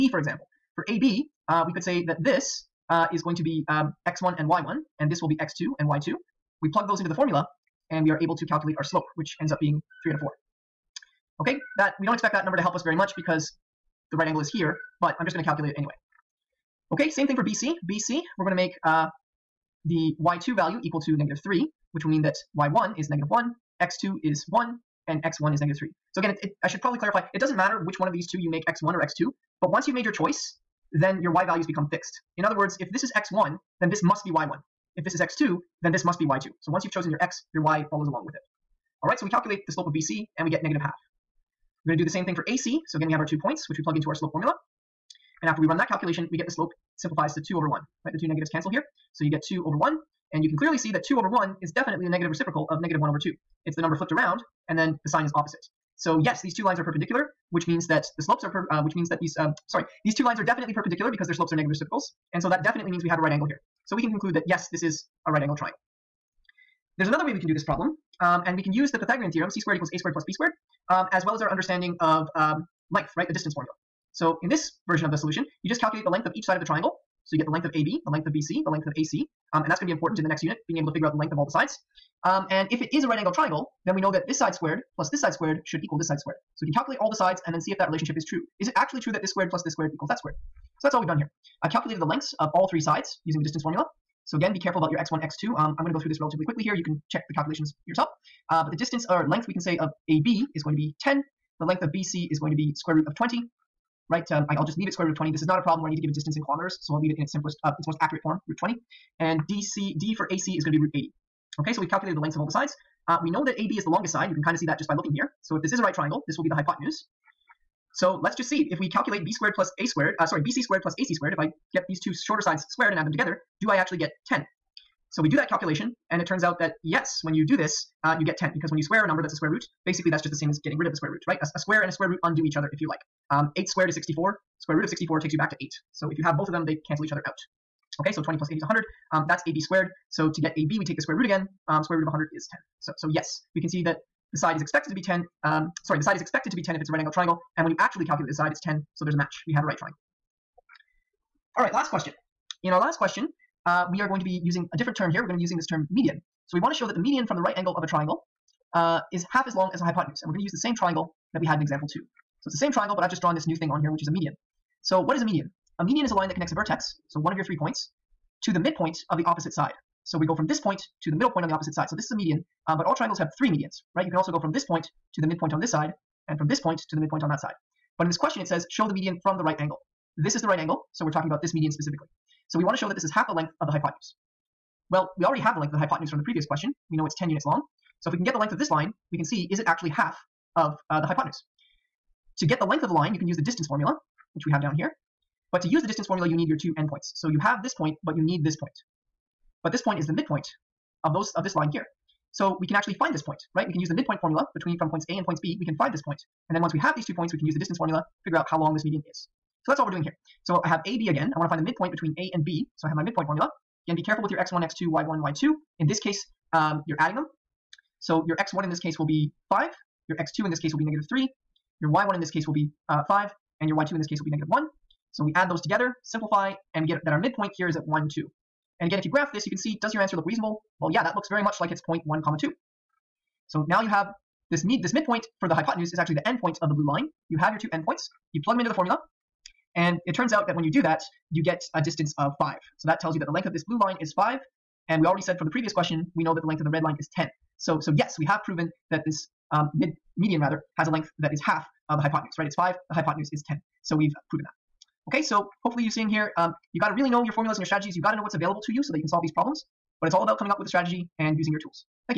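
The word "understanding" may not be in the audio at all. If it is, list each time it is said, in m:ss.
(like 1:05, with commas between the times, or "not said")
1:11.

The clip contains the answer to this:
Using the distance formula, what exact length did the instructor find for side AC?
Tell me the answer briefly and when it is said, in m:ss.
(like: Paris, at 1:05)
root 80, at 1:50.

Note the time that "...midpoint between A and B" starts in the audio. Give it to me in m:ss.
3:31.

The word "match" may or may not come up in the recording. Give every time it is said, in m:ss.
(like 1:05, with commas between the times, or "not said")
2:29.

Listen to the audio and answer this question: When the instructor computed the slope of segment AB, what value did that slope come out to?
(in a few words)
3/4.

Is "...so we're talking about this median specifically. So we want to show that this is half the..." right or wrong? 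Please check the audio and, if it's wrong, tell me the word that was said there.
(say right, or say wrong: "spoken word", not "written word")
right.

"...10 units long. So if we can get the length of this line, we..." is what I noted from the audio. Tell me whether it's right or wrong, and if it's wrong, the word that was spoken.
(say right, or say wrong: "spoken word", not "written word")
right.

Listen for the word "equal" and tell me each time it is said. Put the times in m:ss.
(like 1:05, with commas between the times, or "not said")
0:20, 1:09, 1:25, 1:29.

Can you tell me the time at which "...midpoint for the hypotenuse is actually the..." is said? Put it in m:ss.
3:54.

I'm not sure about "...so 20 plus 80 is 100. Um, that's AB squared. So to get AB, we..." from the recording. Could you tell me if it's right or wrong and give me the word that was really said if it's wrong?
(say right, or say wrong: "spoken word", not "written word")
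right.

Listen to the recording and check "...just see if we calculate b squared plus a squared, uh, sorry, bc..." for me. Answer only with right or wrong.
right.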